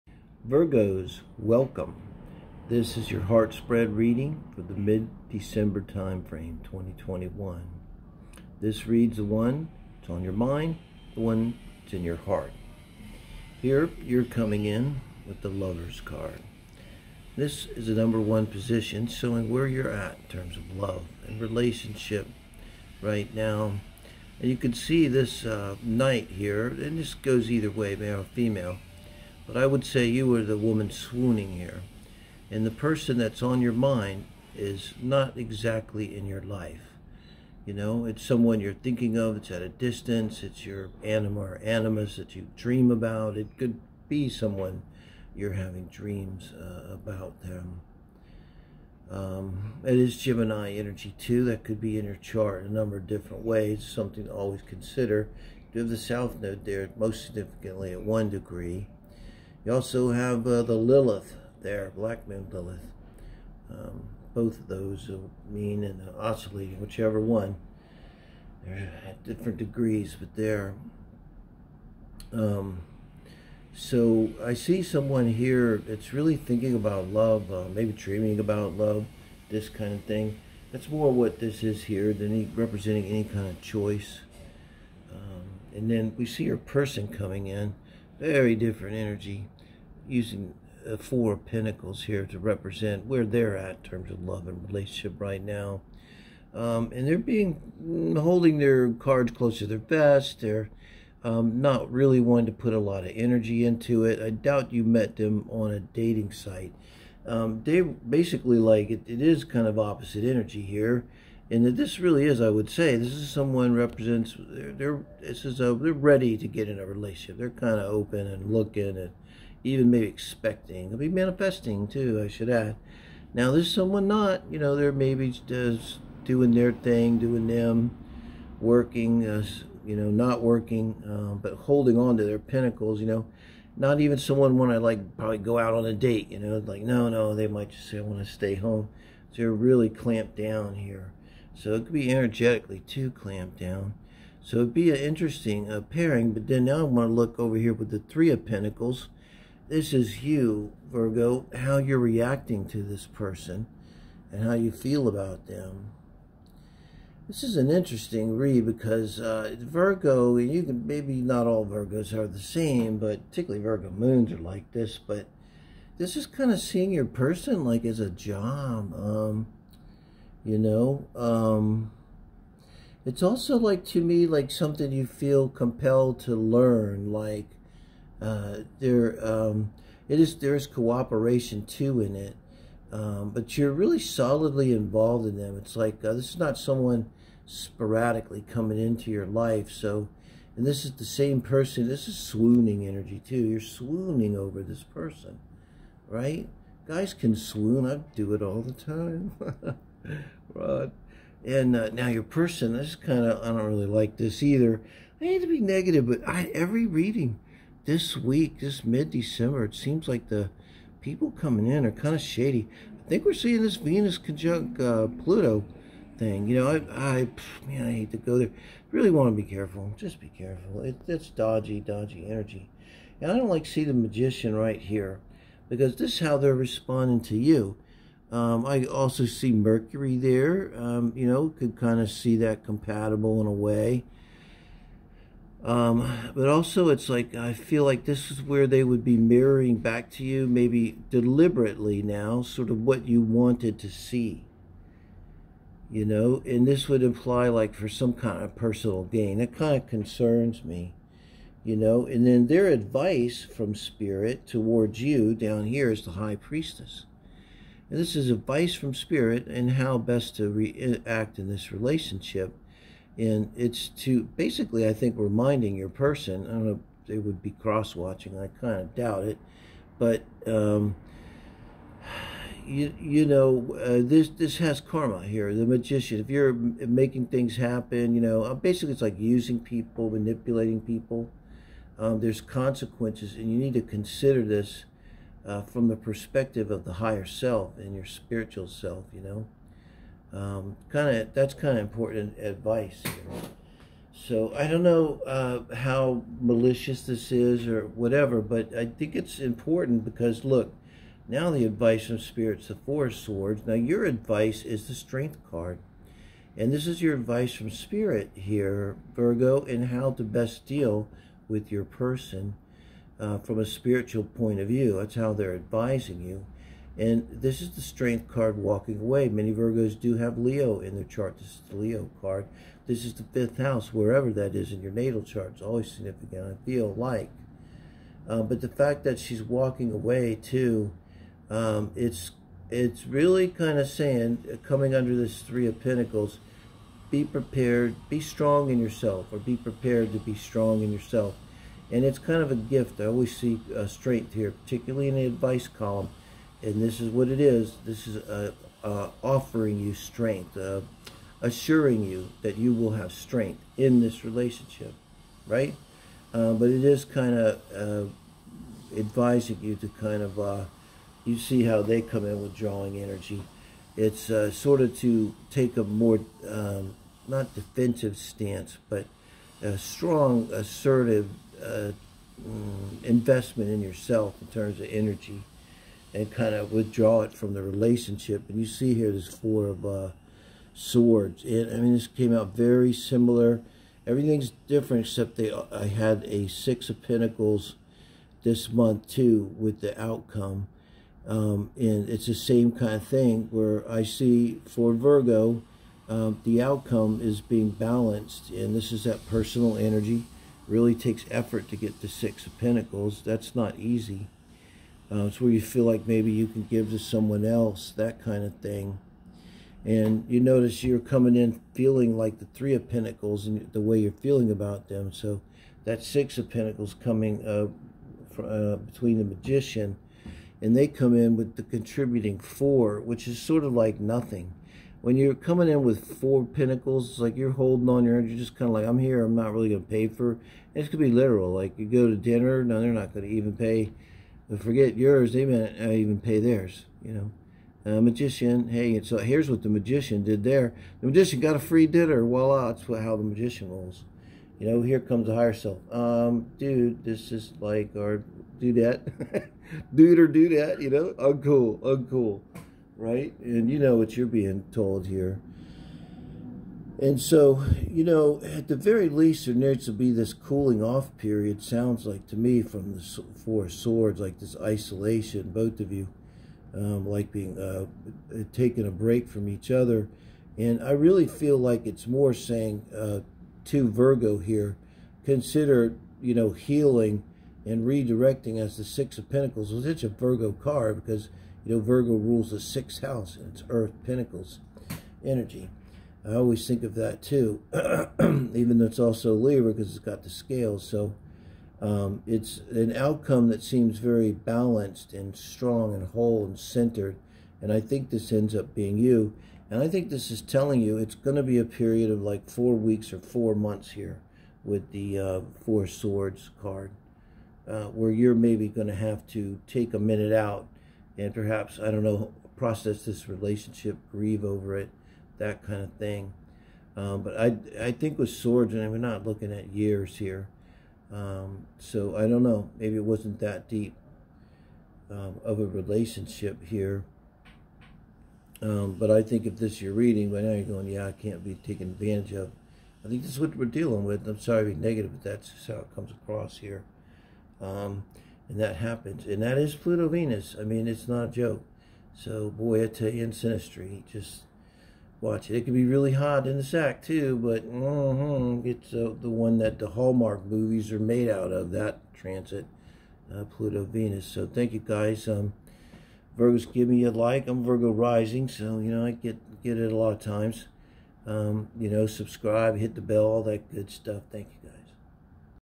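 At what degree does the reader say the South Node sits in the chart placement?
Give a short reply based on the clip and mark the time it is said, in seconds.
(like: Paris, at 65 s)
1, at 58 s.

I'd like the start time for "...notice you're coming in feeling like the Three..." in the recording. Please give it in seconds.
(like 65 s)
410 s.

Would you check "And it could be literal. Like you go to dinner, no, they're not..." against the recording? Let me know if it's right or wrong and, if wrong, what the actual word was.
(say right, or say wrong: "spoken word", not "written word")
right.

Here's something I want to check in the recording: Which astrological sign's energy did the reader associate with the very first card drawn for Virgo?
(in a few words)
Gemini.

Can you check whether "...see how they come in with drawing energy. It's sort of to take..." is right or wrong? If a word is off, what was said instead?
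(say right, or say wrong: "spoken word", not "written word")
right.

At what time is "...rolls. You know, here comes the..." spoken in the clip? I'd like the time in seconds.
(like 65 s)
443 s.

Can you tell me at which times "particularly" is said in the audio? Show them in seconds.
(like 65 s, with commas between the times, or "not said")
163 s, 344 s.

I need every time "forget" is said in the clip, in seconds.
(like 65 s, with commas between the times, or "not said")
434 s.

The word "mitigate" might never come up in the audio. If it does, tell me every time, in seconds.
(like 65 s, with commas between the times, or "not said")
not said.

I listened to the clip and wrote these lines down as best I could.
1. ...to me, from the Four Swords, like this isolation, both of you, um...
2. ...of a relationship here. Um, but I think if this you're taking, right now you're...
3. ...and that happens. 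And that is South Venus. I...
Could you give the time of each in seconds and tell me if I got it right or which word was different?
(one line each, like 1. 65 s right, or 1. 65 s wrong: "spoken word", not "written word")
1. 462 s right
2. 525 s wrong: "reading", not "taking"
3. 538 s wrong: "Pluto", not "South".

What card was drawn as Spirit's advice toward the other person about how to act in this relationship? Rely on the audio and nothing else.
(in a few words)
The High Priestess.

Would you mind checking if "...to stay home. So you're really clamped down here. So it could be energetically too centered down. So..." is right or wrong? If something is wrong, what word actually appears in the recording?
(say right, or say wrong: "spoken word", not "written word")
wrong: "clamped", not "centered".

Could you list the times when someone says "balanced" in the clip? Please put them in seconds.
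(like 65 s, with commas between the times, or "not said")
397 s, 494 s.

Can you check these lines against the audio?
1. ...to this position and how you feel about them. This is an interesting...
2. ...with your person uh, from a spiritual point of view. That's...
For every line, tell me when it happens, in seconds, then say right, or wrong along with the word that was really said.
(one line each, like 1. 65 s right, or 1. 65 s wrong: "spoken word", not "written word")
1. 152 s wrong: "person", not "position"
2. 311 s right.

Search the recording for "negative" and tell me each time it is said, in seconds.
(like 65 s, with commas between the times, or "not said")
205 s, 534 s.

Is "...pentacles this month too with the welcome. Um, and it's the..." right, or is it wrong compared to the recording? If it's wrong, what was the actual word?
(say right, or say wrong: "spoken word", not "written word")
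wrong: "outcome", not "welcome".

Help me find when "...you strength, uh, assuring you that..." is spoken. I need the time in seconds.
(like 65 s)
349 s.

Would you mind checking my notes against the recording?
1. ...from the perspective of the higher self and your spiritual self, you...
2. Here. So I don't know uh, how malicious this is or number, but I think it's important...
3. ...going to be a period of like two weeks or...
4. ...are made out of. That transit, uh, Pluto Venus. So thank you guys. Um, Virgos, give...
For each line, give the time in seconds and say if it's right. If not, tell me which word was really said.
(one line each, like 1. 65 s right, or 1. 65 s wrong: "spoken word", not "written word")
1. 285 s right
2. 293 s wrong: "whatever", not "number"
3. 501 s wrong: "four", not "two"
4. 550 s right.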